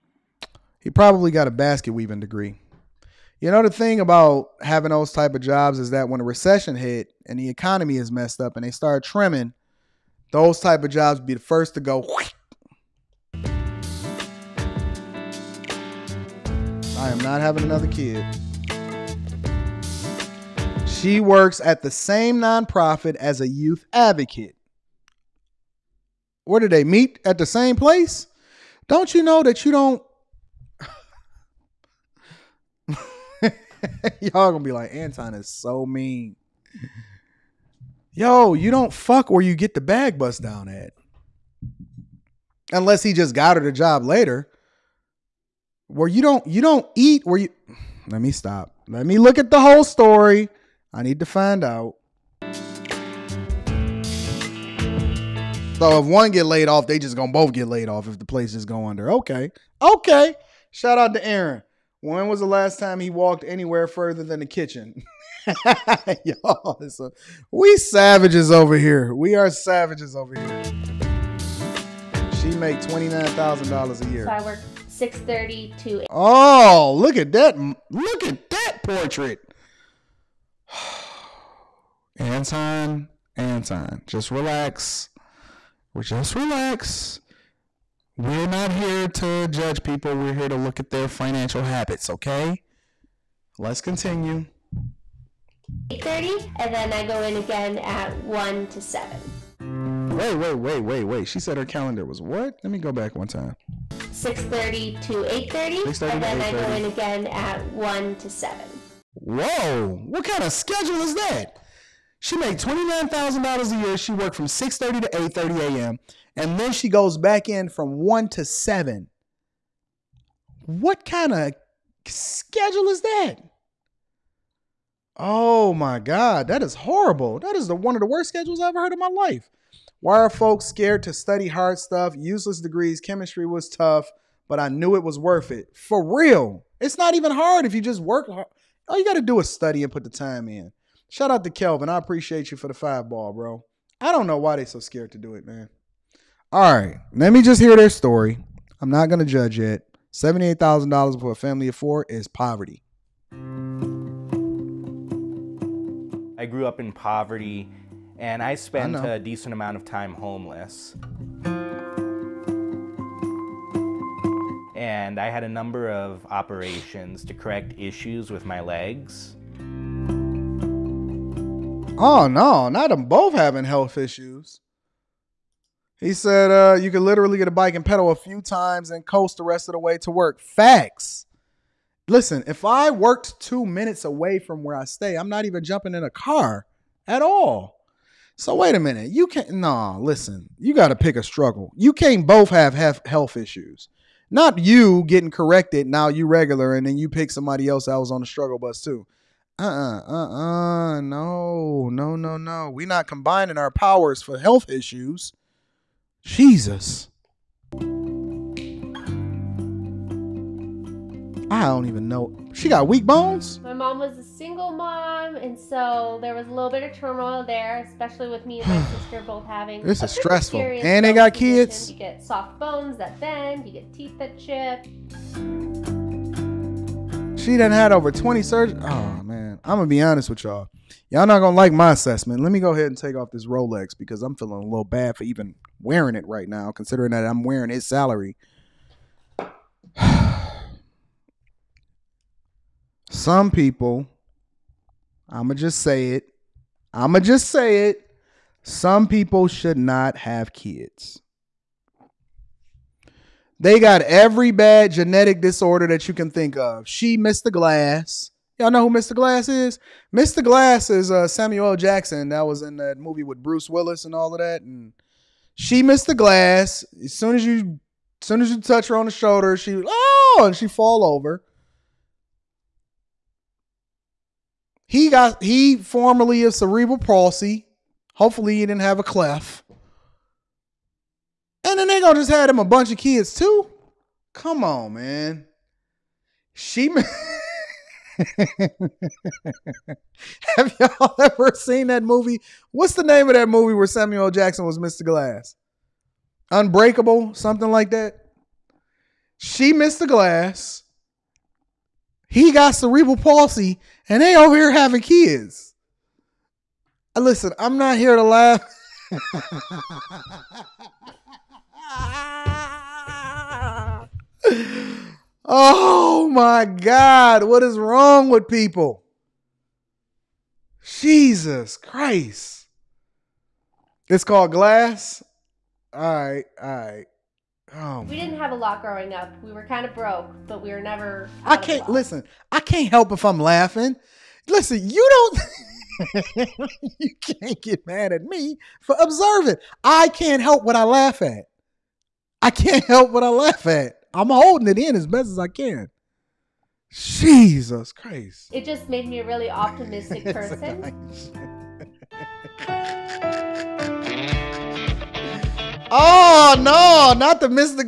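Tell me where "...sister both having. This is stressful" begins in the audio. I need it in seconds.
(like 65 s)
218 s.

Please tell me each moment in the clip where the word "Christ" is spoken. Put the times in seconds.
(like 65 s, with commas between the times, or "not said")
321 s, 347 s.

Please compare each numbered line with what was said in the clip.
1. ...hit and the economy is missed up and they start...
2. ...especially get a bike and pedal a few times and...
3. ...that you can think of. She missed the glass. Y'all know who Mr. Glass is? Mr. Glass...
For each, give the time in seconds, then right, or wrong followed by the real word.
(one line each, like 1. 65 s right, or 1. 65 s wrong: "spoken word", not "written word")
1. 6 s wrong: "messed", not "missed"
2. 177 s wrong: "literally", not "especially"
3. 255 s right.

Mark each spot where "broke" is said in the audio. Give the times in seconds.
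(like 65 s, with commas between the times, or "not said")
329 s.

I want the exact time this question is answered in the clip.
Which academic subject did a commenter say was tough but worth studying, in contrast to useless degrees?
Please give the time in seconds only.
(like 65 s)
133 s.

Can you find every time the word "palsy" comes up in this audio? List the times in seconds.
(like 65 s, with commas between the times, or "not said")
276 s, 303 s.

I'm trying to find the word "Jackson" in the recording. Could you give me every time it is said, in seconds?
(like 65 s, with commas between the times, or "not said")
261 s, 294 s.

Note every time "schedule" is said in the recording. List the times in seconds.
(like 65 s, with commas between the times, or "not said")
110 s, 122 s, 128 s.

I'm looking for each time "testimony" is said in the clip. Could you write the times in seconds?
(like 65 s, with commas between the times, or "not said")
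not said.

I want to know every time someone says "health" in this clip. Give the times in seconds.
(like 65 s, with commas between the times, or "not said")
173 s, 193 s, 204 s.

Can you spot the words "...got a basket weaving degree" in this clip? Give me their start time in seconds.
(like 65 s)
1 s.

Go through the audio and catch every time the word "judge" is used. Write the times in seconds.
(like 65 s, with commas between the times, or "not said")
89 s, 149 s.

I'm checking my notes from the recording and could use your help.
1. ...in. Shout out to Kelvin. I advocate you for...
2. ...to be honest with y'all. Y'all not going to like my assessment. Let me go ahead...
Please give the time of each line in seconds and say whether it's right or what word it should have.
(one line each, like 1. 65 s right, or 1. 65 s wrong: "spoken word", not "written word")
1. 140 s wrong: "appreciate", not "advocate"
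2. 229 s right.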